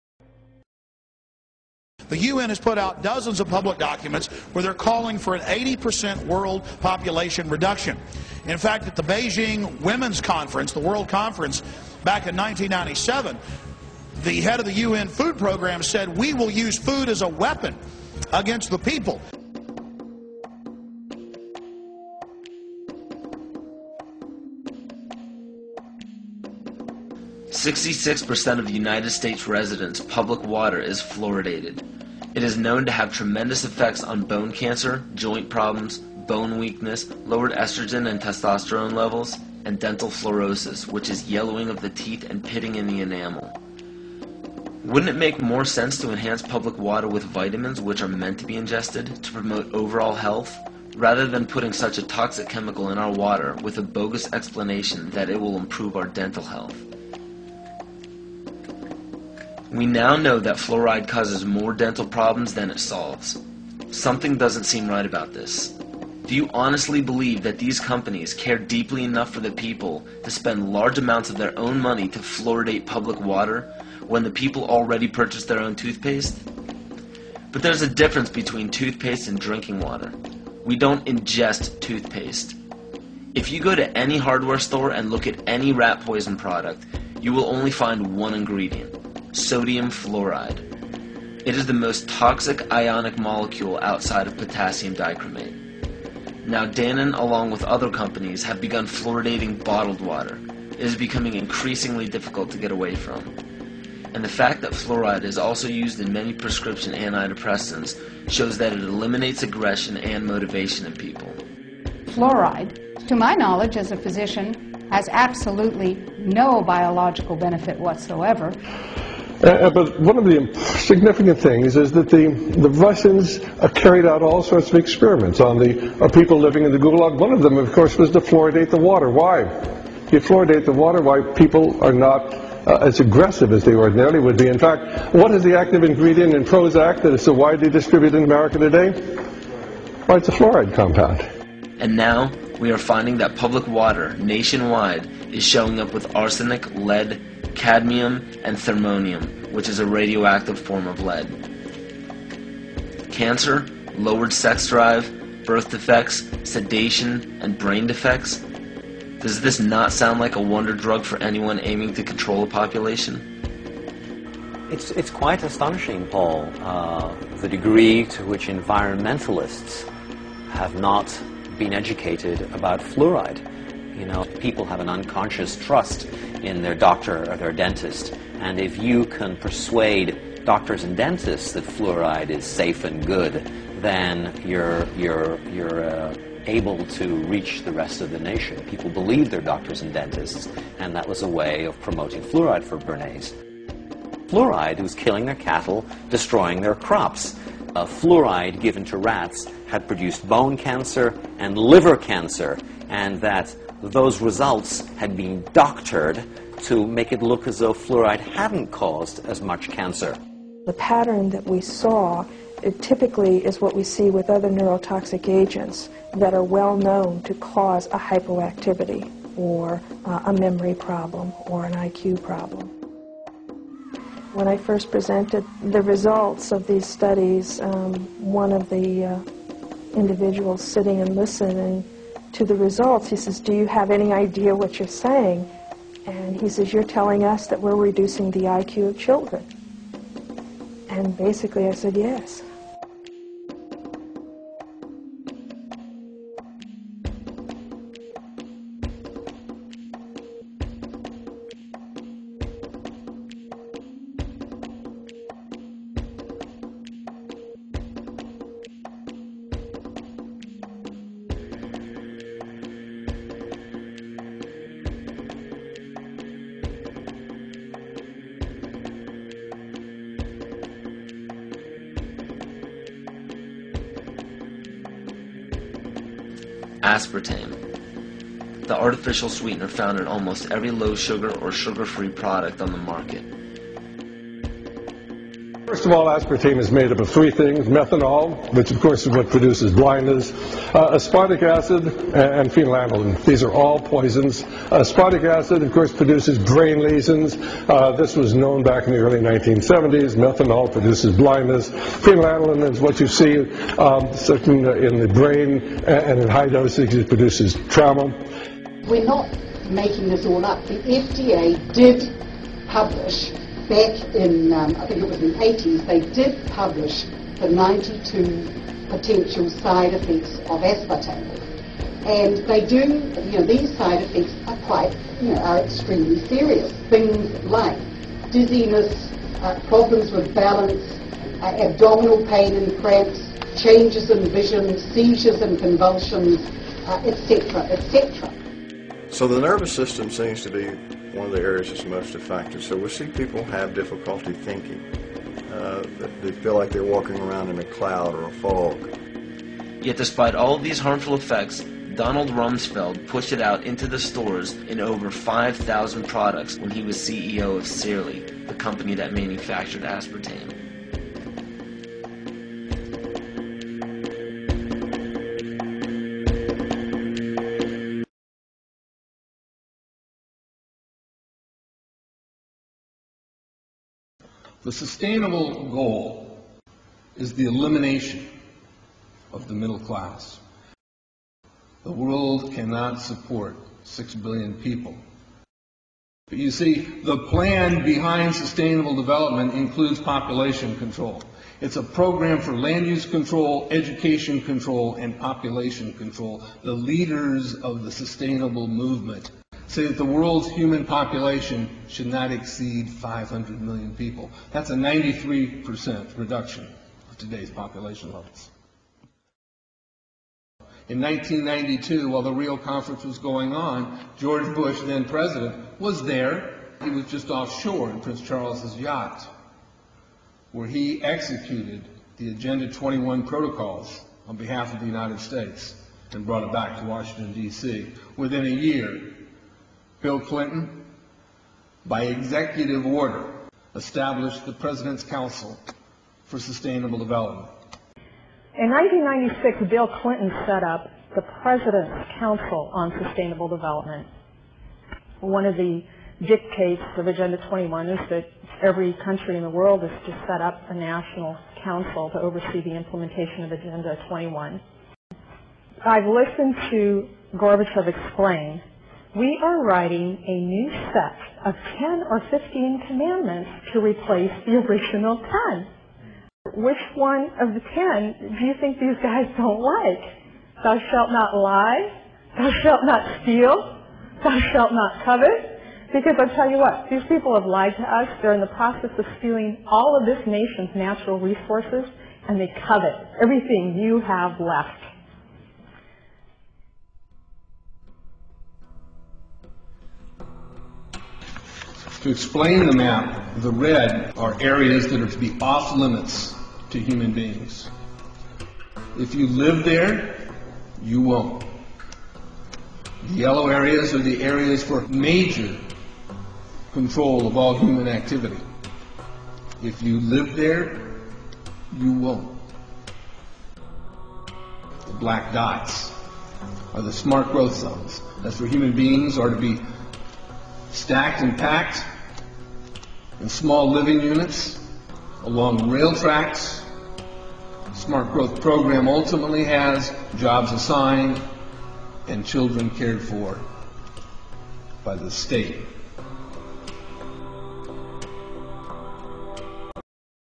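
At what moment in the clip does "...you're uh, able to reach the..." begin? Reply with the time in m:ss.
3:05.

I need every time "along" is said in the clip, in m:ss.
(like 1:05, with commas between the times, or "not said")
1:37, 8:45.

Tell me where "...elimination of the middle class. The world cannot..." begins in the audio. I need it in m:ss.
6:17.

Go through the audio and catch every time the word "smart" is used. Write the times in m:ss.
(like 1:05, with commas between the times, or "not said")
8:36, 8:47.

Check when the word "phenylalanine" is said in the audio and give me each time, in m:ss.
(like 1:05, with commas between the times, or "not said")
4:52, 5:01.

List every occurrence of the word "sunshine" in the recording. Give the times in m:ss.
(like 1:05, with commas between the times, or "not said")
not said.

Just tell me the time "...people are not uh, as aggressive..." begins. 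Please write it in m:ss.
2:11.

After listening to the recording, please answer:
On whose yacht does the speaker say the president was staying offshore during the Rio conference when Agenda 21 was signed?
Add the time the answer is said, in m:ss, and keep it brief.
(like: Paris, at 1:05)
Prince Charles, at 6:58.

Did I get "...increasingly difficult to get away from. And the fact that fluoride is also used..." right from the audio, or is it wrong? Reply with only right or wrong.
right.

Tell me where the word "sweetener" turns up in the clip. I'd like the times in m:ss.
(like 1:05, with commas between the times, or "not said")
4:39.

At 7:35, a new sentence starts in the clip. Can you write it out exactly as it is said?
I've listened to Gorbachev explain we are writing a new set of 10 or 15 commandments to replace the original 10.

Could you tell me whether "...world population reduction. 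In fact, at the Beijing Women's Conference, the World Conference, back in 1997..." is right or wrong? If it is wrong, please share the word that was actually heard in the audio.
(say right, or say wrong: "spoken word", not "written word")
right.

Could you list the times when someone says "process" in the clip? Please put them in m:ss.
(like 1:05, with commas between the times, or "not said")
7:58.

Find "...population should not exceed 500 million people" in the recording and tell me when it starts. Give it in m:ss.
6:40.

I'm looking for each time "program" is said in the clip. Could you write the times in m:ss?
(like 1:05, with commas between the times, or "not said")
0:15, 6:31, 8:48.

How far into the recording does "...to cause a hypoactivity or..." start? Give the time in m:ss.
3:37.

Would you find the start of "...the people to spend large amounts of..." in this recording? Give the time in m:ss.
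1:09.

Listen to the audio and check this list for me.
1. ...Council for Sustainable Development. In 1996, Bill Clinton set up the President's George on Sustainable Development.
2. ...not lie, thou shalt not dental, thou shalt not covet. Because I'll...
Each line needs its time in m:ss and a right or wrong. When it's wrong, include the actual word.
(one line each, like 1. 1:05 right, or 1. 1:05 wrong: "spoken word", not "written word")
1. 7:15 wrong: "Council", not "George"
2. 7:51 wrong: "steal", not "dental".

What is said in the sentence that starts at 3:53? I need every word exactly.
He says, do you have any idea what you're saying?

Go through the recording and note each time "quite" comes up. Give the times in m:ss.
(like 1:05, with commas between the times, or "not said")
2:45, 5:24.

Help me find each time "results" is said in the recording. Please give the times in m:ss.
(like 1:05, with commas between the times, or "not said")
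3:24, 3:45, 3:52.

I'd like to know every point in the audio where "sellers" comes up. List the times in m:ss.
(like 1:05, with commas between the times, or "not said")
not said.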